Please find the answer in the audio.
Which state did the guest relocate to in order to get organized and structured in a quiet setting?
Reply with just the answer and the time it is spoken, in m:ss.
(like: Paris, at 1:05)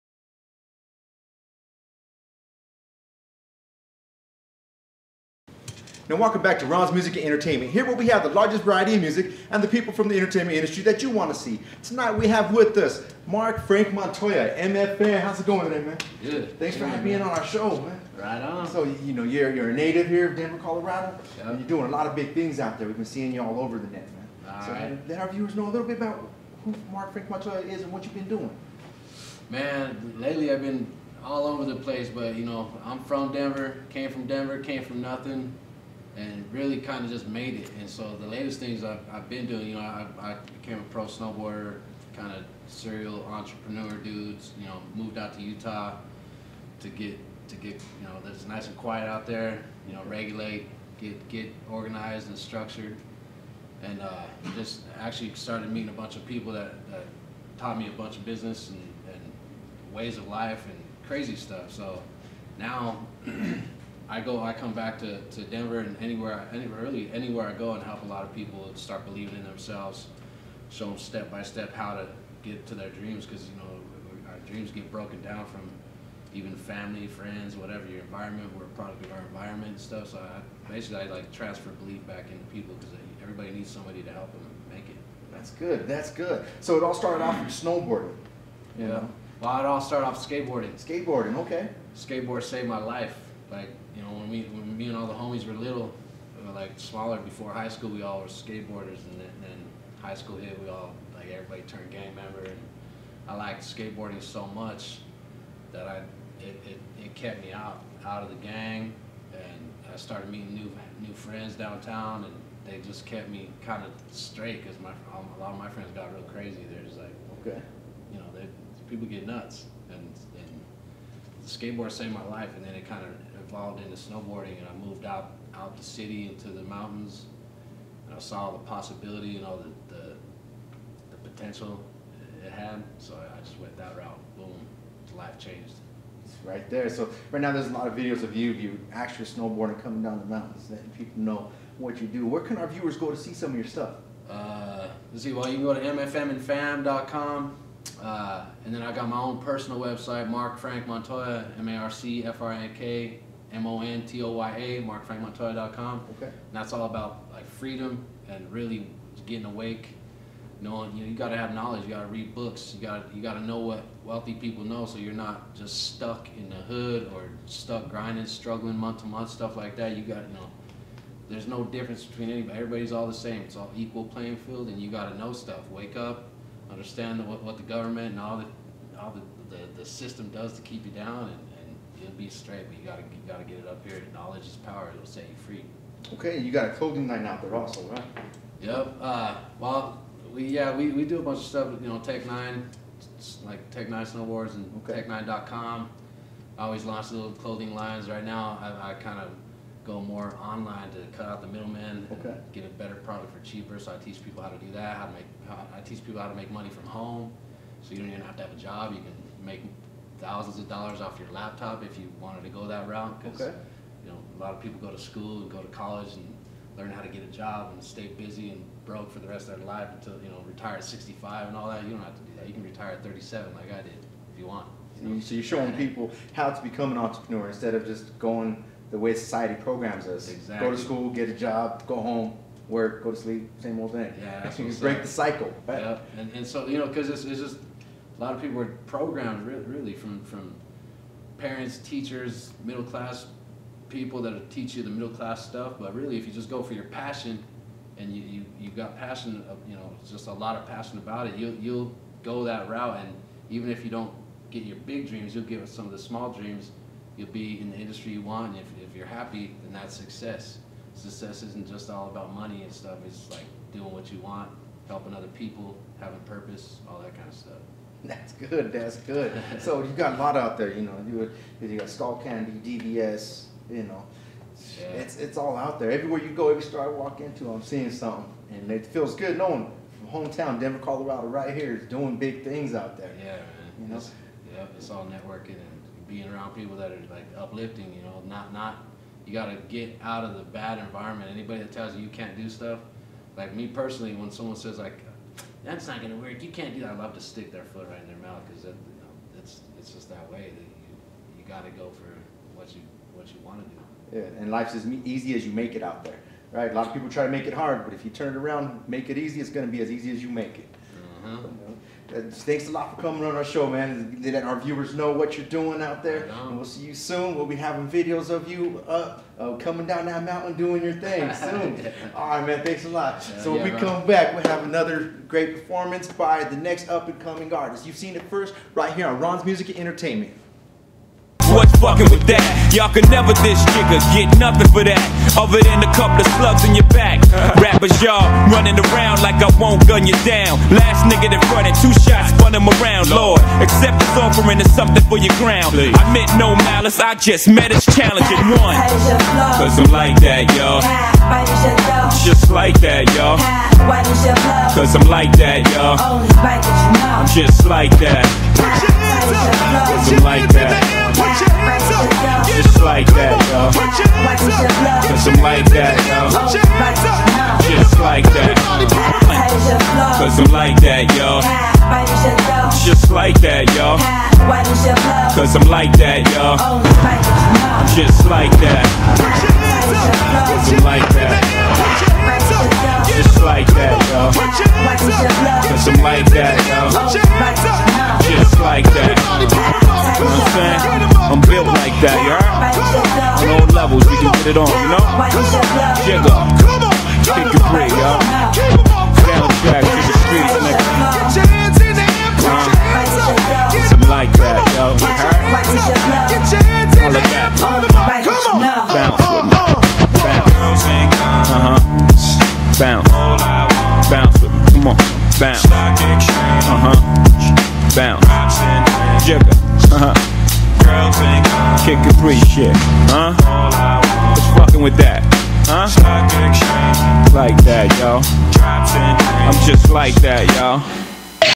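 Utah, at 0:45.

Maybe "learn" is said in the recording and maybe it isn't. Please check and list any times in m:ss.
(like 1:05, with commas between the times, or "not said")
3:36.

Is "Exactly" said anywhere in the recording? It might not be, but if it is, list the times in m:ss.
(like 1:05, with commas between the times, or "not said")
3:50.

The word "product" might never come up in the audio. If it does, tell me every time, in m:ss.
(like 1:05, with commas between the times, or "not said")
1:18, 3:22.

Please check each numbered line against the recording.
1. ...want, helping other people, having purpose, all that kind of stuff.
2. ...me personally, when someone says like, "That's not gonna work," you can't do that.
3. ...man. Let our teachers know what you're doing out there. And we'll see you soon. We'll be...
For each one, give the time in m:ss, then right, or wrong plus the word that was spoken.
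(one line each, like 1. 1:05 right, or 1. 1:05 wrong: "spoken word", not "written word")
1. 4:24 right
2. 4:53 right
3. 5:13 wrong: "viewers", not "teachers".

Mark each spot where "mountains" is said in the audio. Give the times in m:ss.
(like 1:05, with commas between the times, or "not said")
2:06, 2:20, 5:20.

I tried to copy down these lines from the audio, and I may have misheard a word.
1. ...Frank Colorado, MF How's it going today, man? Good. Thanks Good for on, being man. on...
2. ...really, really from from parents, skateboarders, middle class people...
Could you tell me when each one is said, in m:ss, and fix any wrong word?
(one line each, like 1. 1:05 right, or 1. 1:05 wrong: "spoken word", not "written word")
1. 0:13 wrong: "Montoya", not "Colorado"
2. 3:59 wrong: "teachers", not "skateboarders".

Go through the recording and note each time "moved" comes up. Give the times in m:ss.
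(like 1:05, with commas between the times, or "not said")
0:44, 2:04.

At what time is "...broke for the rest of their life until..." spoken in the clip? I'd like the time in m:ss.
3:38.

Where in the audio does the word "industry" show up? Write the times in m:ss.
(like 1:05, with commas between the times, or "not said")
0:10, 4:17.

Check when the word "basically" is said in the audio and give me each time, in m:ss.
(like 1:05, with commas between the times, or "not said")
1:20.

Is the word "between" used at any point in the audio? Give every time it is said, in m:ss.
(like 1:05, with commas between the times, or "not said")
2:52.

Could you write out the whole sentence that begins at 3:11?
You know, Technine, like Technine Snowboards and okay.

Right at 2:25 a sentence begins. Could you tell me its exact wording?
Well, you can go to mfmandfam.com uh, and then I got my own personal website, Marc Frank Montoya, M-A-R-C-F-R-A-N-K, M-O-N-T-O-Y-A, marcfrankmontoya.com.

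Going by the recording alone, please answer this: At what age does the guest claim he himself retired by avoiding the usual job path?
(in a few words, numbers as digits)
37.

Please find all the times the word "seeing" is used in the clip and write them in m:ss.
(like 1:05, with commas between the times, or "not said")
0:23, 4:37.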